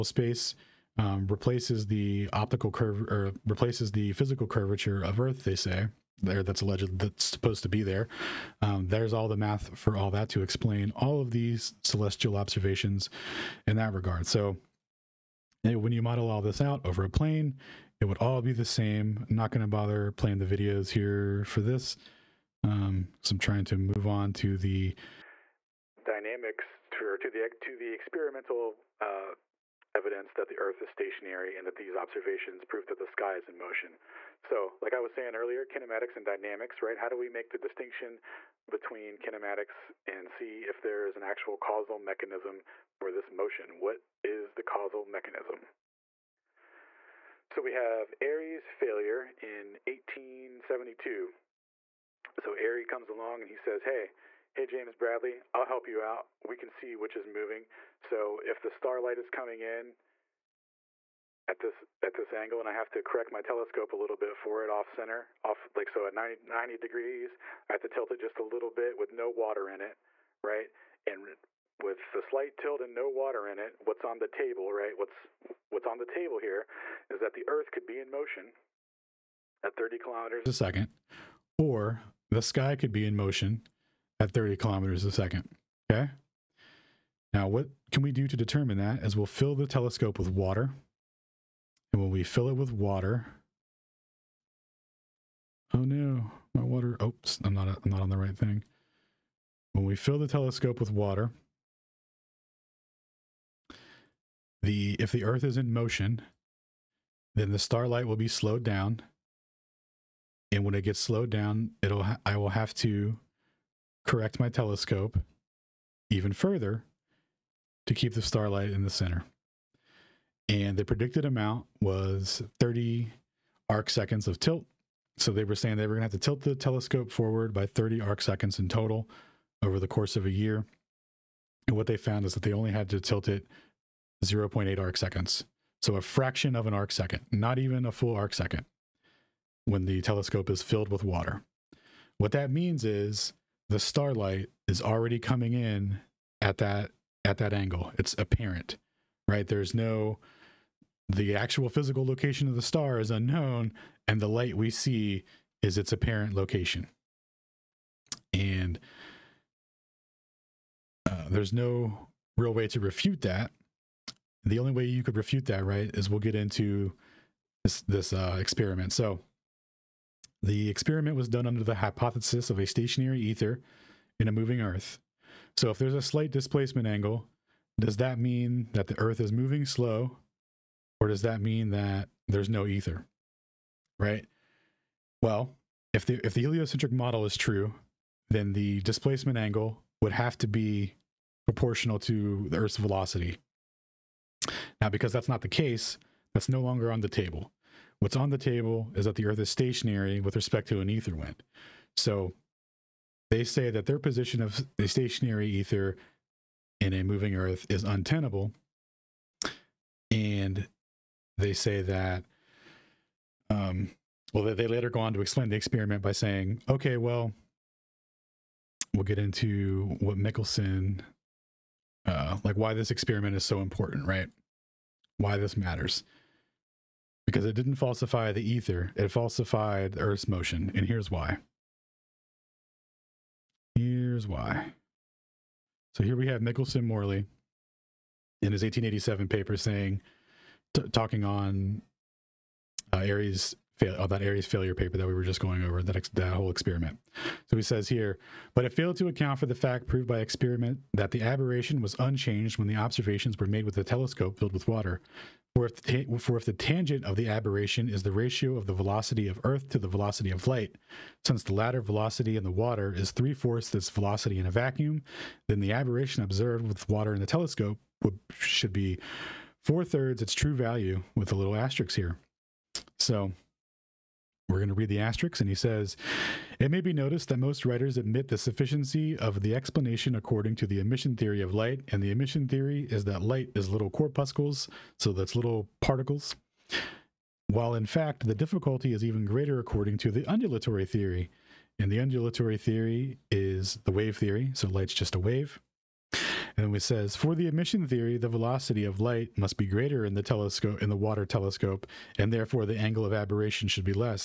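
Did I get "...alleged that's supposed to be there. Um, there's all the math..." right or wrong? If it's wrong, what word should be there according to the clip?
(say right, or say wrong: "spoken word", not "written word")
right.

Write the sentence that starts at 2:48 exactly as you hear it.
So the experiment was done under the hypothesis of a stationary ether in a moving Earth.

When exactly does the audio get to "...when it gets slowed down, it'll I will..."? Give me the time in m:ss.
1:50.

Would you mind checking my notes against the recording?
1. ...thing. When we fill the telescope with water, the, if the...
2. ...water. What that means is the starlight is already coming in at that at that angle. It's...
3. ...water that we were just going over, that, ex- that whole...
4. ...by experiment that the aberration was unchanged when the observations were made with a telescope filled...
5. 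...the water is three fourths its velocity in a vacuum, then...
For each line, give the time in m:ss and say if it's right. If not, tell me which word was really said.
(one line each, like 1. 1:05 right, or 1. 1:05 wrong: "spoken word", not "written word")
1. 1:38 right
2. 2:21 right
3. 4:04 wrong: "paper", not "water"
4. 4:10 right
5. 4:22 right.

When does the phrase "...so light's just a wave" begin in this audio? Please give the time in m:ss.
4:54.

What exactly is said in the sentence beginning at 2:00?
And the predicted amount was 30 arc seconds of tilt.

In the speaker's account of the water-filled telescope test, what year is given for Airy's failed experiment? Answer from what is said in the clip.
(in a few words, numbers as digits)
1872.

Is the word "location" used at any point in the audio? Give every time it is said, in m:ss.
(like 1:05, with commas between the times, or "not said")
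2:32, 2:36.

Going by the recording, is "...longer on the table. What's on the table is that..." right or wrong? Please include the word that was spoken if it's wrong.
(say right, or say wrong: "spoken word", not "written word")
right.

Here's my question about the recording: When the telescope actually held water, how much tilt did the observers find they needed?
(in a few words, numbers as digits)
0.8 arc seconds.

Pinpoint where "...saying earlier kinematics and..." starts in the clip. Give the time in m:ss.
0:35.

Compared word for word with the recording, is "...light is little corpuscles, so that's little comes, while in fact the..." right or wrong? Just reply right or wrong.
wrong.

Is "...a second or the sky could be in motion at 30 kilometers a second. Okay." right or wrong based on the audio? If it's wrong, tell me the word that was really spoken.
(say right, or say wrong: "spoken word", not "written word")
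right.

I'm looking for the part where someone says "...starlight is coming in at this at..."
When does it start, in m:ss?
0:58.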